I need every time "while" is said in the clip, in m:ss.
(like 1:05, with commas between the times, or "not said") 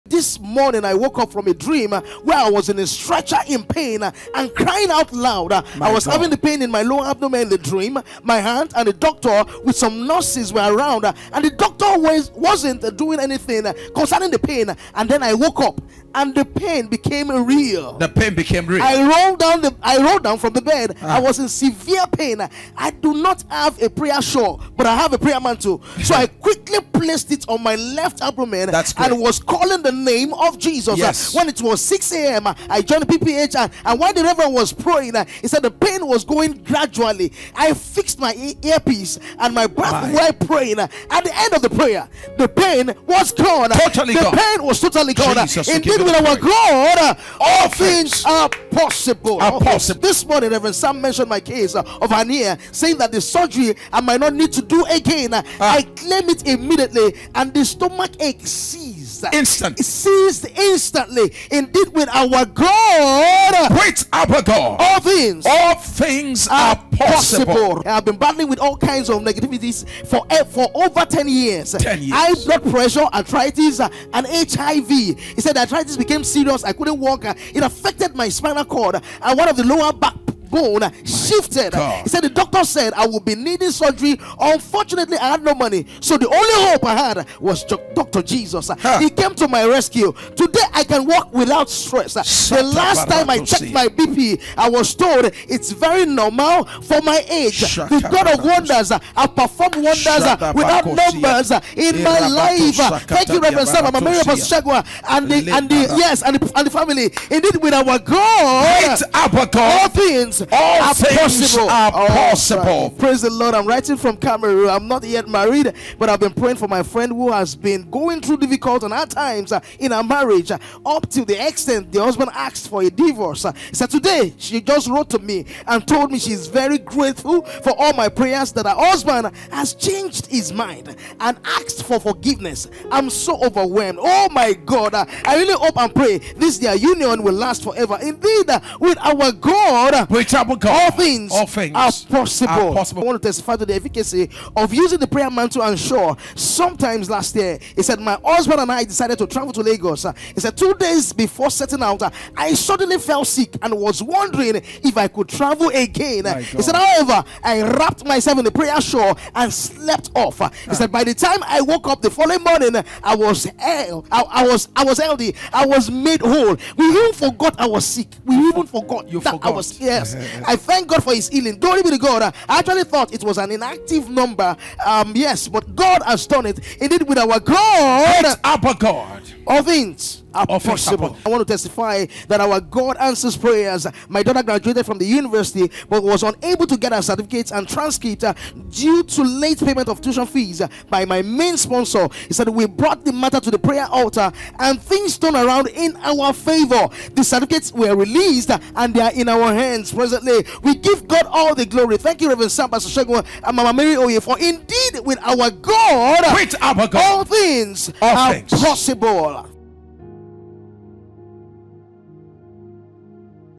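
0:33, 0:40.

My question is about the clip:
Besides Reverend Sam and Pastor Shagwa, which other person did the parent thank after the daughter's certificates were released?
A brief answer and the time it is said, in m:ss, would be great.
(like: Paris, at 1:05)
Mama Mary Oye, at 3:23.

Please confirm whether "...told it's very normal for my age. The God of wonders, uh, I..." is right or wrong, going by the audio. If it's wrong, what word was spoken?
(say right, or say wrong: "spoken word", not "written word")
right.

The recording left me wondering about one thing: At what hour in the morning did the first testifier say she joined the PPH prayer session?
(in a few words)
6 a.m.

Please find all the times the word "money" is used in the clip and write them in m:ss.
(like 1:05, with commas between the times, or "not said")
1:25.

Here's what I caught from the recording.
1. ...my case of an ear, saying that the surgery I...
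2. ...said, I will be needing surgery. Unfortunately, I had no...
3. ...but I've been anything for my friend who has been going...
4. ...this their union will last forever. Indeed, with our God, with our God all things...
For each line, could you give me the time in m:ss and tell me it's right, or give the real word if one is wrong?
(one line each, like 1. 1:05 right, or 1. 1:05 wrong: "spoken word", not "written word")
1. 0:51 right
2. 1:22 right
3. 1:55 wrong: "praying", not "anything"
4. 2:16 right.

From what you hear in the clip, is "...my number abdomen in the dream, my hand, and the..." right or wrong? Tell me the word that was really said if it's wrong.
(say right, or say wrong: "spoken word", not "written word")
wrong: "lower", not "number".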